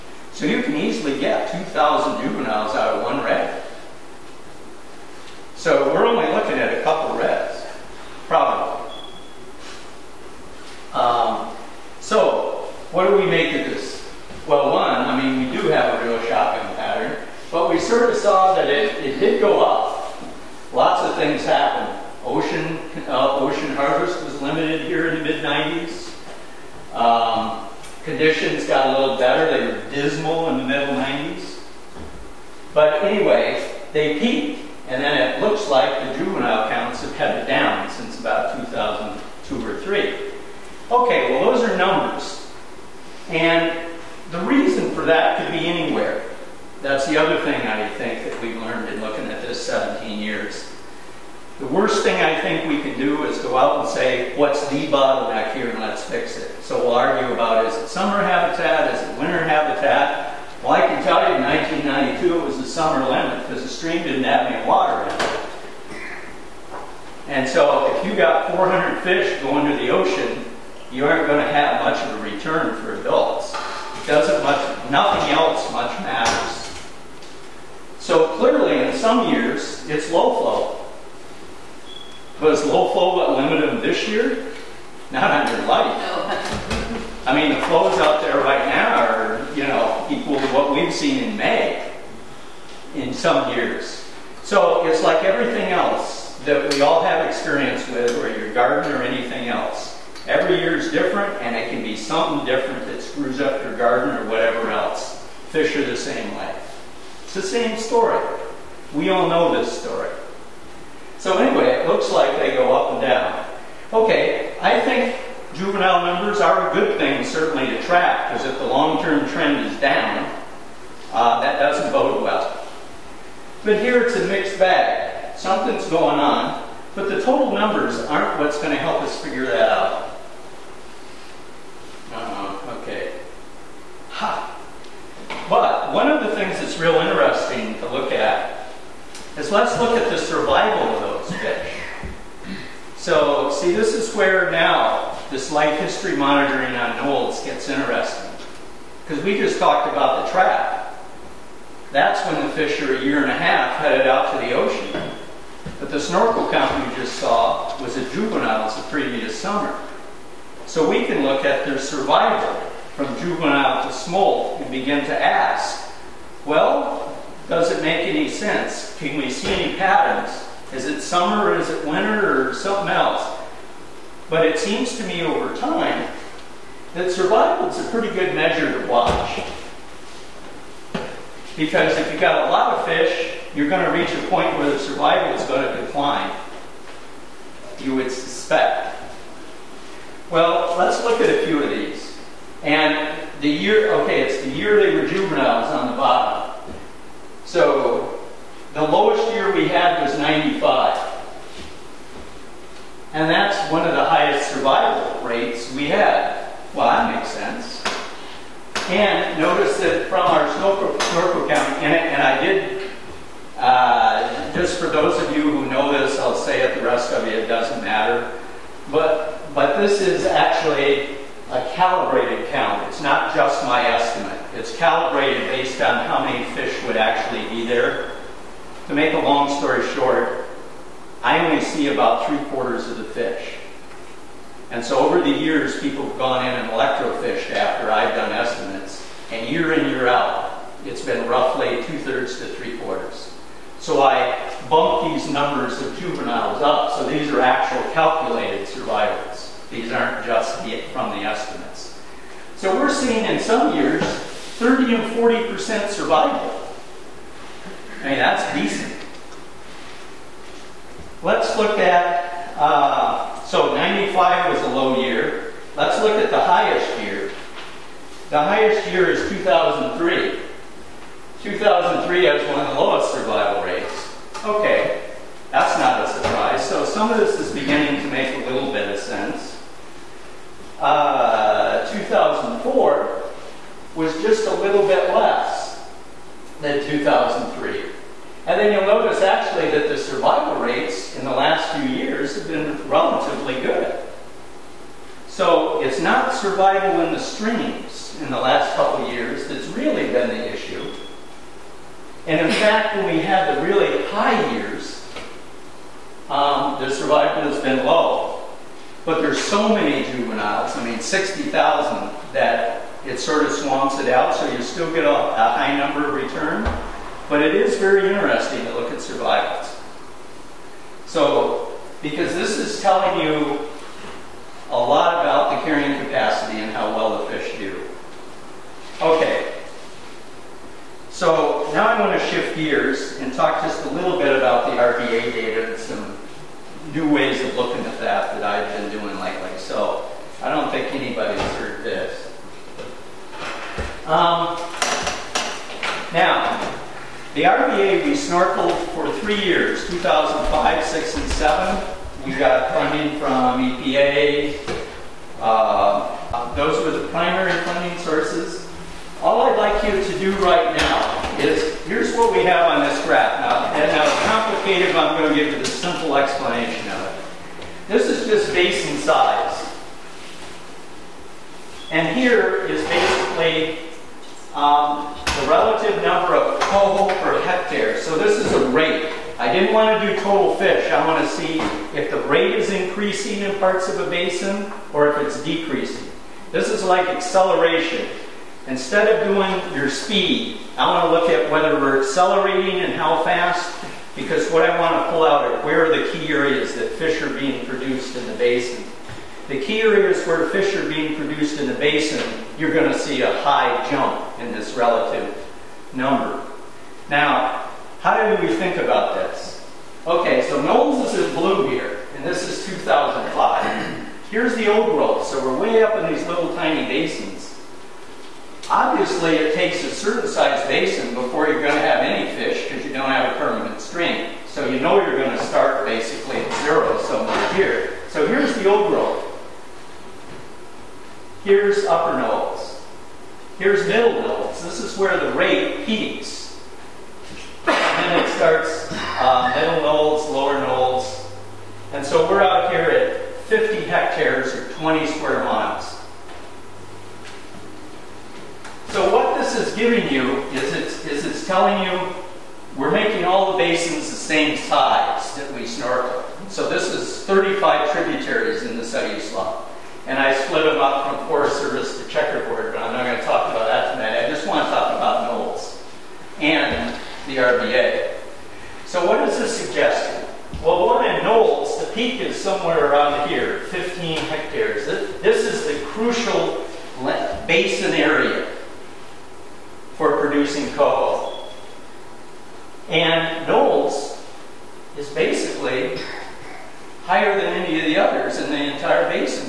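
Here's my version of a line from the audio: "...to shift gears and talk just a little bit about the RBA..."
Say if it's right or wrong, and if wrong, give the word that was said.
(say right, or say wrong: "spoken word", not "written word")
right.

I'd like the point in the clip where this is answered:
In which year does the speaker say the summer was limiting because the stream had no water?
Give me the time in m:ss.
1:01.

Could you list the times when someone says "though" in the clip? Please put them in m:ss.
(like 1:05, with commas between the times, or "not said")
not said.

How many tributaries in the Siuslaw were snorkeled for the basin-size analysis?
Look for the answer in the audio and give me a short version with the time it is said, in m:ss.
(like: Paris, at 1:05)
35, at 7:37.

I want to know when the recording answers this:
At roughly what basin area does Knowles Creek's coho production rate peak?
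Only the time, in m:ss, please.
7:53.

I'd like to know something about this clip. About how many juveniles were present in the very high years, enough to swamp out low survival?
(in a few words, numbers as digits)
60,000.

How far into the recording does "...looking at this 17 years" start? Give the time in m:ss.
0:49.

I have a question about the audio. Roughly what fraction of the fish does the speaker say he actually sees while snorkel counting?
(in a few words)
three quarters.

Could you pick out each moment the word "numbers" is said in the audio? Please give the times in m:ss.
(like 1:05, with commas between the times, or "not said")
0:41, 1:56, 2:07, 4:05, 5:15, 6:16, 6:45.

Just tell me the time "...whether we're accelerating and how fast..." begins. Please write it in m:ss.
6:31.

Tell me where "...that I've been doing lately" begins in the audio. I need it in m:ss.
5:38.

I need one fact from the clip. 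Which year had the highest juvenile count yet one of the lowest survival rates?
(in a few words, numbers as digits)
2003.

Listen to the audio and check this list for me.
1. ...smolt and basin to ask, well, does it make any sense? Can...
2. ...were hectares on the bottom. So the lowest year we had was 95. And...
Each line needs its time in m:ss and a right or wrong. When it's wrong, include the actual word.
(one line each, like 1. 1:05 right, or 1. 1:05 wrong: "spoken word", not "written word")
1. 2:43 wrong: "begin", not "basin"
2. 3:14 wrong: "juveniles", not "hectares".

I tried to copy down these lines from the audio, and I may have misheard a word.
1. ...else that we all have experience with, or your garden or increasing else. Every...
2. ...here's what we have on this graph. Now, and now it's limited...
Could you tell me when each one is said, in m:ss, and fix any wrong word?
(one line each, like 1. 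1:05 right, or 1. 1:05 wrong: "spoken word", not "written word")
1. 1:35 wrong: "anything", not "increasing"
2. 6:01 wrong: "complicated", not "limited".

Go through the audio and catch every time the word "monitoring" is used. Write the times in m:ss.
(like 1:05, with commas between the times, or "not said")
2:26.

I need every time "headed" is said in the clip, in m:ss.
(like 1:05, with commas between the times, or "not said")
0:37, 2:33.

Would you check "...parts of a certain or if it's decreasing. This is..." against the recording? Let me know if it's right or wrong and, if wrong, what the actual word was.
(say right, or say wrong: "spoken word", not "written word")
wrong: "basin", not "certain".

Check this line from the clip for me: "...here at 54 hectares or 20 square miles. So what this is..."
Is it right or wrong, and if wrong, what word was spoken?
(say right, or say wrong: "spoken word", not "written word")
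wrong: "50", not "54".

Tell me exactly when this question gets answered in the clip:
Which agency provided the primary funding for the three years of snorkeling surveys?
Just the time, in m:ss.
5:53.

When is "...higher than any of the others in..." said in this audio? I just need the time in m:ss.
8:07.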